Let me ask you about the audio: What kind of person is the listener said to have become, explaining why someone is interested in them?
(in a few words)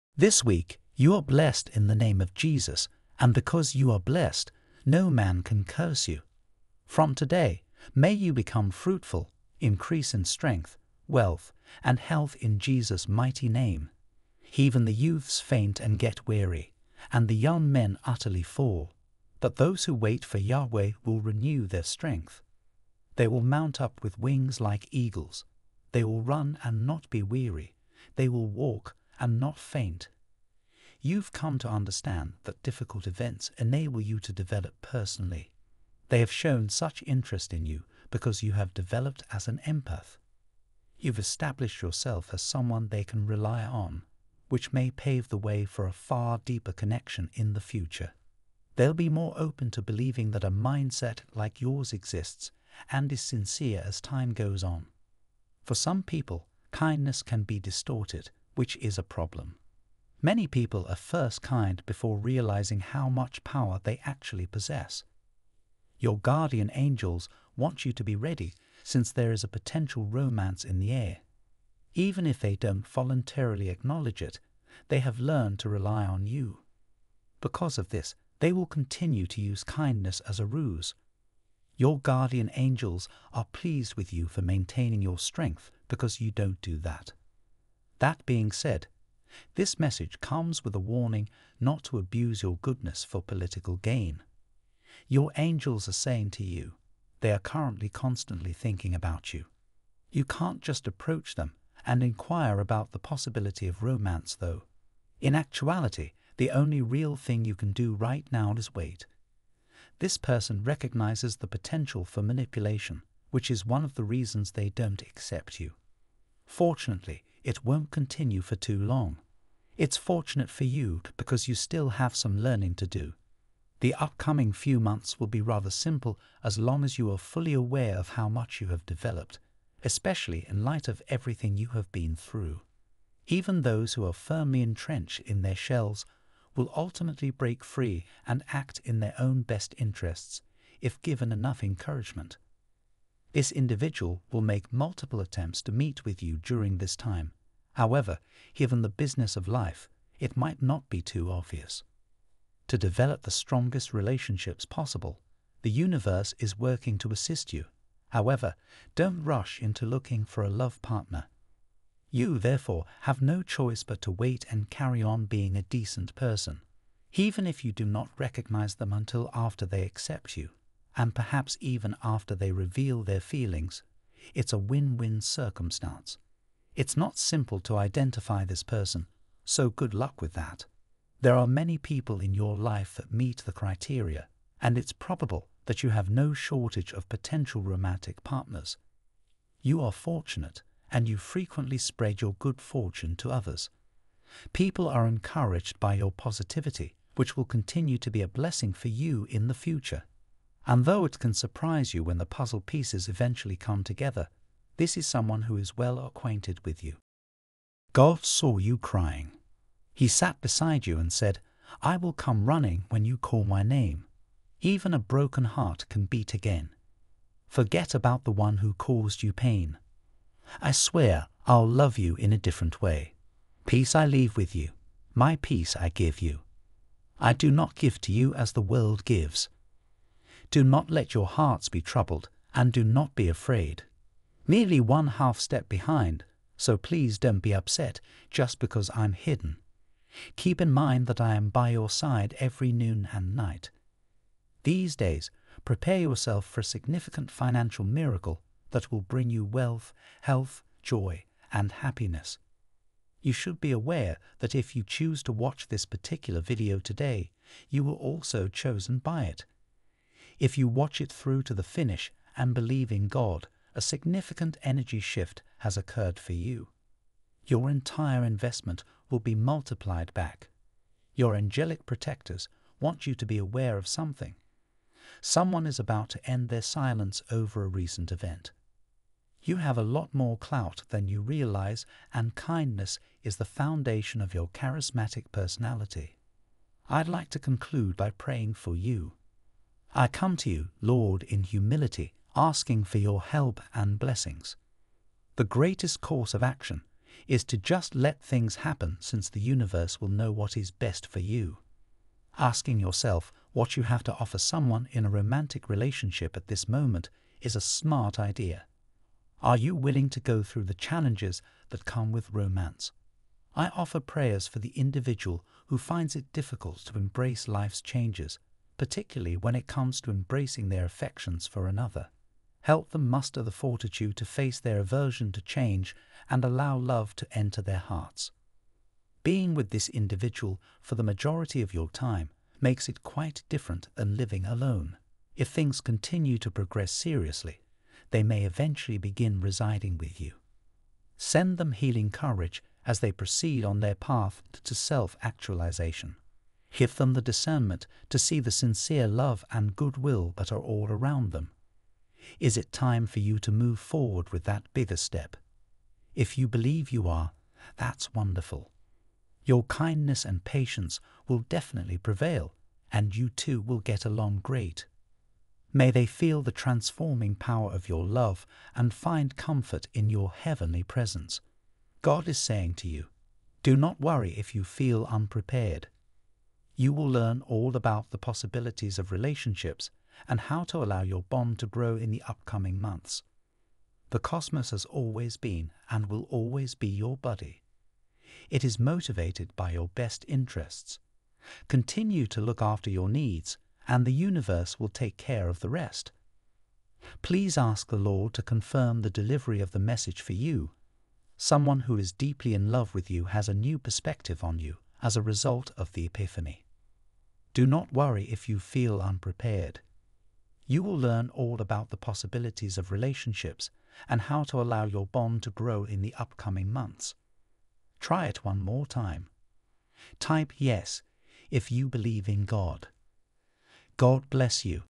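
empath.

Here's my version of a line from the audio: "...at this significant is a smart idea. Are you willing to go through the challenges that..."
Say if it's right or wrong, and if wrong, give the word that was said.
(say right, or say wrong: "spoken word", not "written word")
wrong: "moment", not "significant".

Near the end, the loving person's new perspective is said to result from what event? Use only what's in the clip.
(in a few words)
the Epiphany.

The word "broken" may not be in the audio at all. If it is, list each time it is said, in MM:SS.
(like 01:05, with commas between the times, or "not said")
03:34.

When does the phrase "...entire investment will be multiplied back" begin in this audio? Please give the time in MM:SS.
04:27.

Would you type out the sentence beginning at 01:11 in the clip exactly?
Even if they don't voluntarily acknowledge it, they have learned to rely on you.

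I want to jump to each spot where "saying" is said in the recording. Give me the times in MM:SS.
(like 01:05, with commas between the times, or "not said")
01:35, 06:12.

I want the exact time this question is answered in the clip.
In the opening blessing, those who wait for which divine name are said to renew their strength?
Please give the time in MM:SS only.
00:20.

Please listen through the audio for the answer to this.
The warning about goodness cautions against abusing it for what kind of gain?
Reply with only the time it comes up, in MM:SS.
01:33.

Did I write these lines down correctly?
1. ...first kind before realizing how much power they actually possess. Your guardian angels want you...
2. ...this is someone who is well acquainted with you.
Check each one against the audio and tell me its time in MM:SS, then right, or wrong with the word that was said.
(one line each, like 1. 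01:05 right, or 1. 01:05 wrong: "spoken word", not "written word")
1. 01:00 right
2. 03:24 right.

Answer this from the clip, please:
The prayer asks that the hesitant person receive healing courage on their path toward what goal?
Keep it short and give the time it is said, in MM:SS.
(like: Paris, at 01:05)
self actualization, at 05:44.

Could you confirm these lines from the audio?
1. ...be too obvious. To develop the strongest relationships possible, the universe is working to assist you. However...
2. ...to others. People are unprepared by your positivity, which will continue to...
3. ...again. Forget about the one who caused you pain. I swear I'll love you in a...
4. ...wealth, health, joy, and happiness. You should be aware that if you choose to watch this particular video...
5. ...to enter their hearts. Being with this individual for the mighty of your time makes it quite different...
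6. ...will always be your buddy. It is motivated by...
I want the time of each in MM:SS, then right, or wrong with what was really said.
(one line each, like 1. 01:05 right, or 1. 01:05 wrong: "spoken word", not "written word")
1. 02:30 right
2. 03:13 wrong: "encouraged", not "unprepared"
3. 03:36 right
4. 04:09 right
5. 05:27 wrong: "majority", not "mighty"
6. 06:26 right.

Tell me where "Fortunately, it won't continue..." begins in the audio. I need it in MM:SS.
01:56.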